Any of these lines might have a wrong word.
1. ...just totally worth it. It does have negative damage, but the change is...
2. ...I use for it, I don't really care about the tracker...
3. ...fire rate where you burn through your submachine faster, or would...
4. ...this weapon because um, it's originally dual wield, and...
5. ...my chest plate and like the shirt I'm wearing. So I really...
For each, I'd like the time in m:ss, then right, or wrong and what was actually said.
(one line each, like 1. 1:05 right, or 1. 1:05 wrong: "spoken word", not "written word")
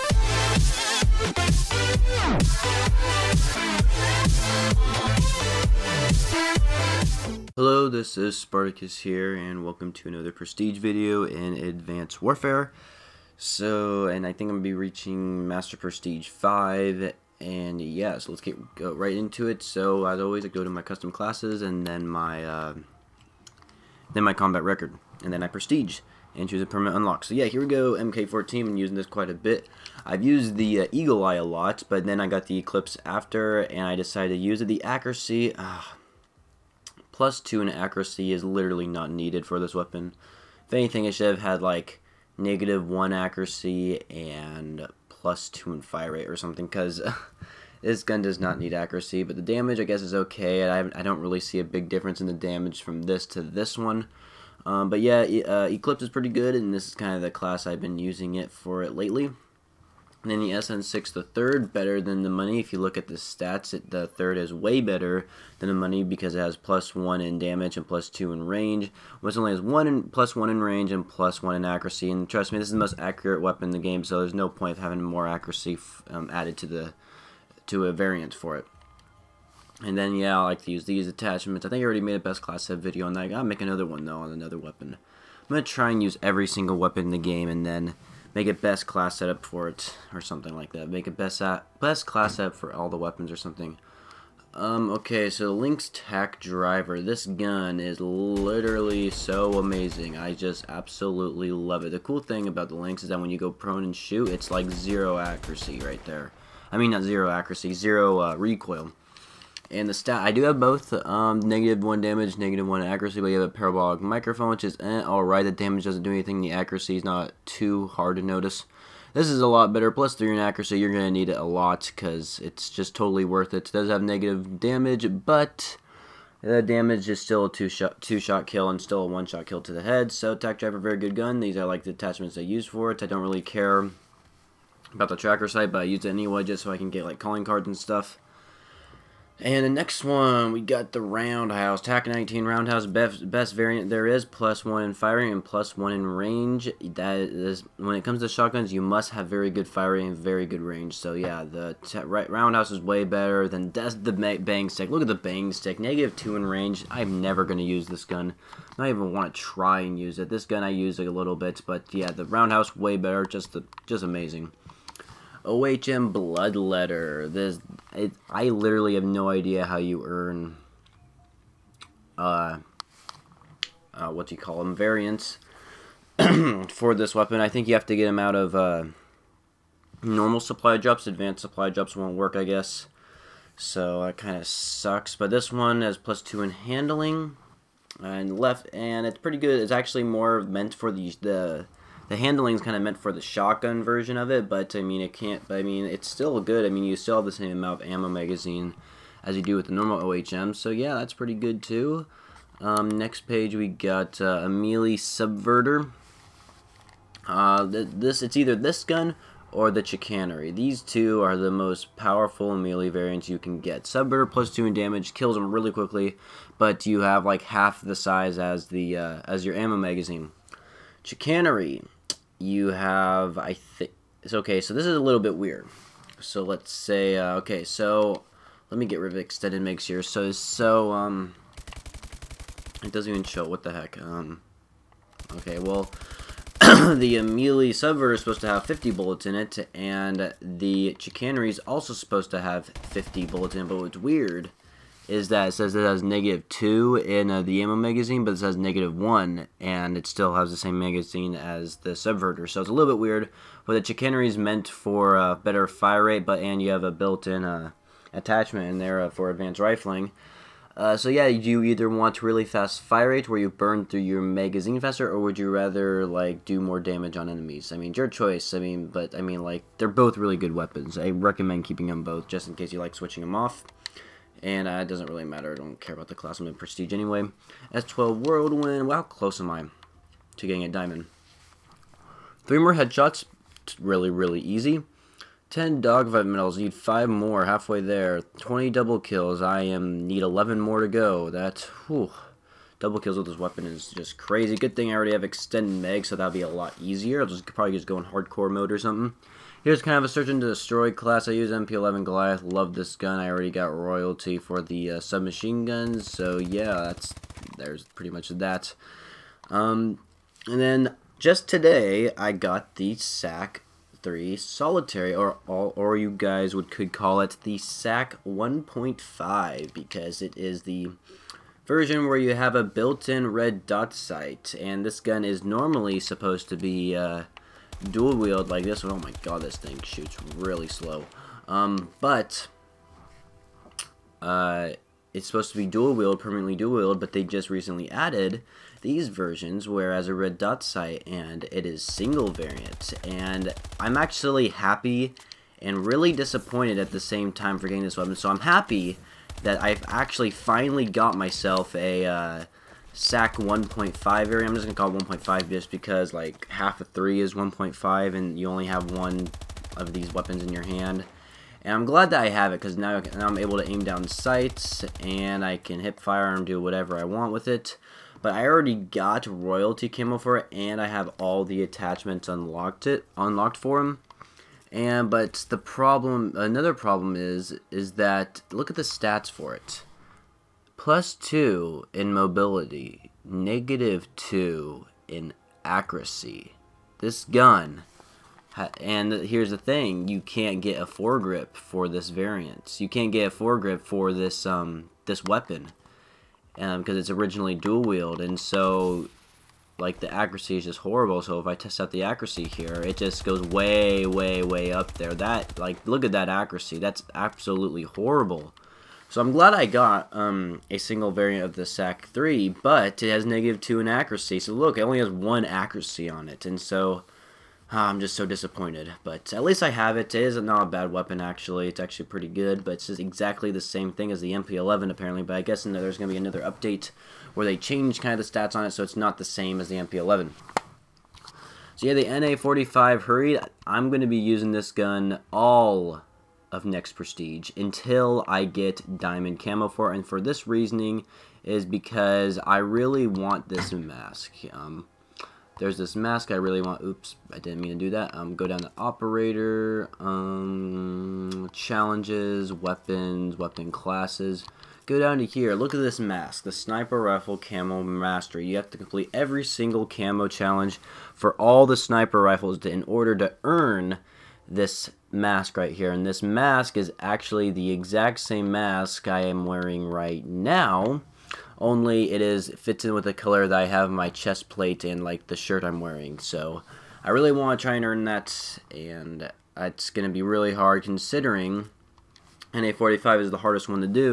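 1. 2:02 wrong: "damage", not "change"
2. 2:12 right
3. 4:22 wrong: "magazine", not "submachine"
4. 6:35 right
5. 7:53 right.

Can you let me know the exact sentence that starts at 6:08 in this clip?
But I already got royalty camo for it and I have all the attachments unlocked it unlocked for him.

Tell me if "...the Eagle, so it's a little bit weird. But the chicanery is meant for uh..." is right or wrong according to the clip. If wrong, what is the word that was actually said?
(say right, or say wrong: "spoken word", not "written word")
wrong: "Subverter", not "Eagle".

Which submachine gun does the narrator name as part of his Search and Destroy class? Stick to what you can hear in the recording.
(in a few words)
MP11 Goliath.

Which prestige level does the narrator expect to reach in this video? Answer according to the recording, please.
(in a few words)
Master Prestige 5.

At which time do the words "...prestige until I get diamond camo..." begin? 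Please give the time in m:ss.
7:16.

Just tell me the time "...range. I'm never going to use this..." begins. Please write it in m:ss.
2:36.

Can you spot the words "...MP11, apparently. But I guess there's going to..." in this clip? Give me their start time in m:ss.
7:04.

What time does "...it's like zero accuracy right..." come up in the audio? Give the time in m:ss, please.
1:44.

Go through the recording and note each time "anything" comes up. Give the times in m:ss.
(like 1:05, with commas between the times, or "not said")
0:40, 1:56.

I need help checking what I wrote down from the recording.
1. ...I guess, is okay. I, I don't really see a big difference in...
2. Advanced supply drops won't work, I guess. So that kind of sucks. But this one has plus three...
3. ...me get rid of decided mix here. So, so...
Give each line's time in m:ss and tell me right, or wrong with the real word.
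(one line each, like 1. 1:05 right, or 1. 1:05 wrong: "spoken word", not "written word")
1. 0:49 right
2. 3:01 wrong: "two", not "three"
3. 3:48 wrong: "extended", not "decided".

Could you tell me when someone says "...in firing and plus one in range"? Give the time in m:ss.
2:24.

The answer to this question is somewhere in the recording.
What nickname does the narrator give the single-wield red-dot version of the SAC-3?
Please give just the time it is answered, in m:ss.
5:17.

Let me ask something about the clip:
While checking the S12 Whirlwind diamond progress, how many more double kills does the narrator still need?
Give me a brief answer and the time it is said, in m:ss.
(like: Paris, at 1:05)
11, at 4:50.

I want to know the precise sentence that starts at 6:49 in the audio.
So I'm glad I got um, a single variant of the SAC-3, but it has negative 2 in accuracy.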